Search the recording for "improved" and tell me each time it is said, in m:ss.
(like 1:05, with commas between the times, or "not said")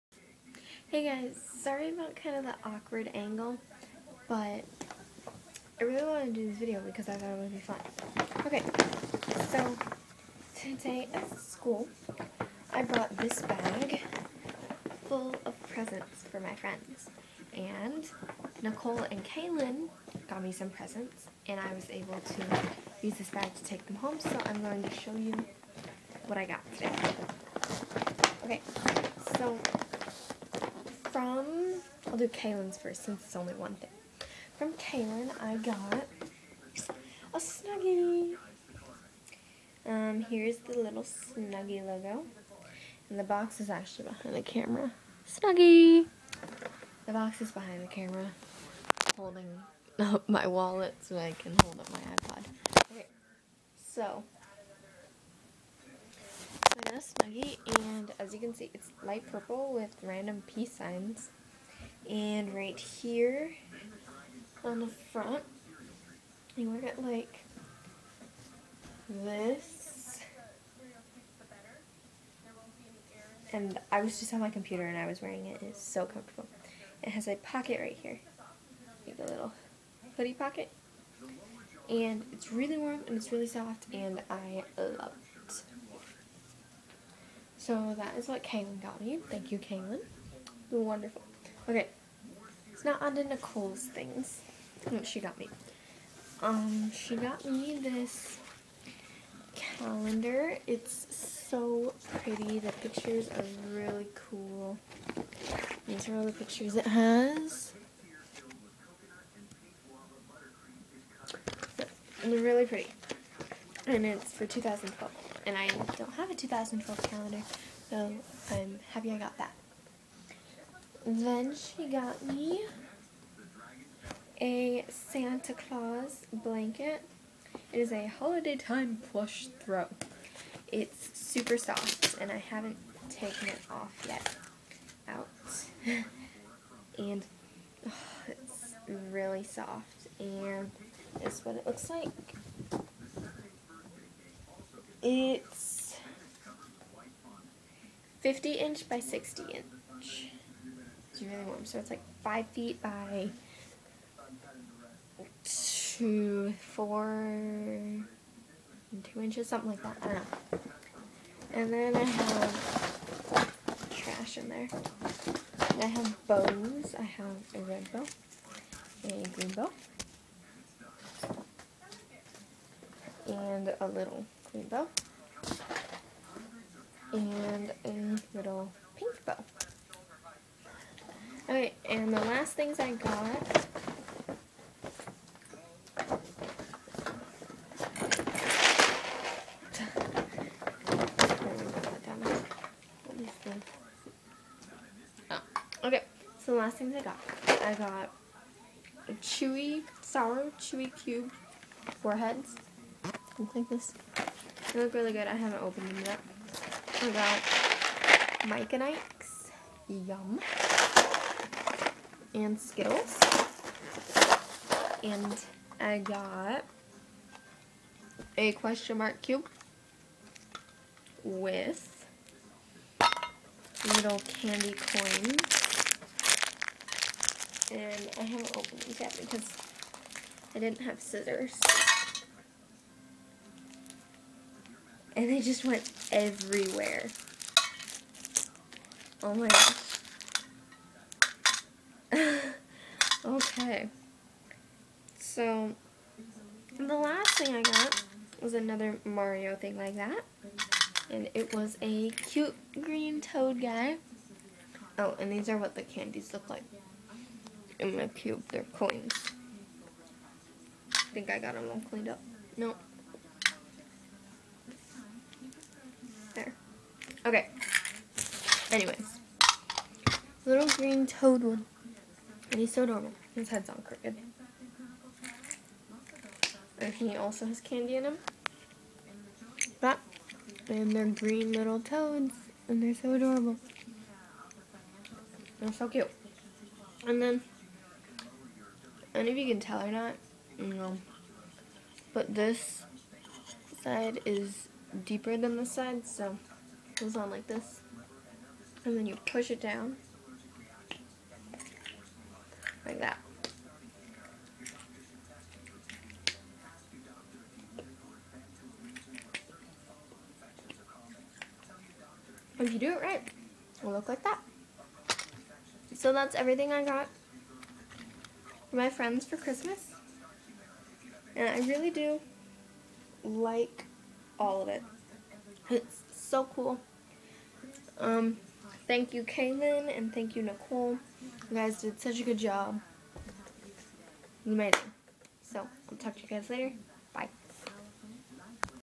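not said.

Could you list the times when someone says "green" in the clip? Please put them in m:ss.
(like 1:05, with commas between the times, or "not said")
2:49, 2:54, 4:12, 4:30, 4:41.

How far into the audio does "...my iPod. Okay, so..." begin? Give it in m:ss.
0:51.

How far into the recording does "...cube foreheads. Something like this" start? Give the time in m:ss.
3:21.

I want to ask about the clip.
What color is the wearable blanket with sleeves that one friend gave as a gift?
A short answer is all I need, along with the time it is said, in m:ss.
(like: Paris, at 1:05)
Light purple, at 0:59.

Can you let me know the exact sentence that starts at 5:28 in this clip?
Um, thank you, Kaylin, and thank you, Nicole.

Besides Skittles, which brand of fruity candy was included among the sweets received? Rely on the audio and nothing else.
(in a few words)
Mike and Ike's.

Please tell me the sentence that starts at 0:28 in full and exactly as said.
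Okay, so from, I'll do Kaylin's first since it's only one thing.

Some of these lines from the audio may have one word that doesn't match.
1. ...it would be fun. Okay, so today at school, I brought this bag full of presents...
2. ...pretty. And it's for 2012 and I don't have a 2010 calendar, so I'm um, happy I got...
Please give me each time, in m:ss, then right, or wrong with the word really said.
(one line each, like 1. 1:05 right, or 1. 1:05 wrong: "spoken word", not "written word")
1. 0:07 right
2. 1:52 wrong: "2012", not "2010".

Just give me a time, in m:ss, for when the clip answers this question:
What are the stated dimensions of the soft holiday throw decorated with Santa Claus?
2:28.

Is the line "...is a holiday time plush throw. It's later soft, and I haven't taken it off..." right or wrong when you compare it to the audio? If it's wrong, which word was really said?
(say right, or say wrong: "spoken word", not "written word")
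wrong: "super", not "later".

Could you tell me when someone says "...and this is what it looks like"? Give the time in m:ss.
2:20.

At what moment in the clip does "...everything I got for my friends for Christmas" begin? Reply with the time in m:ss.
5:16.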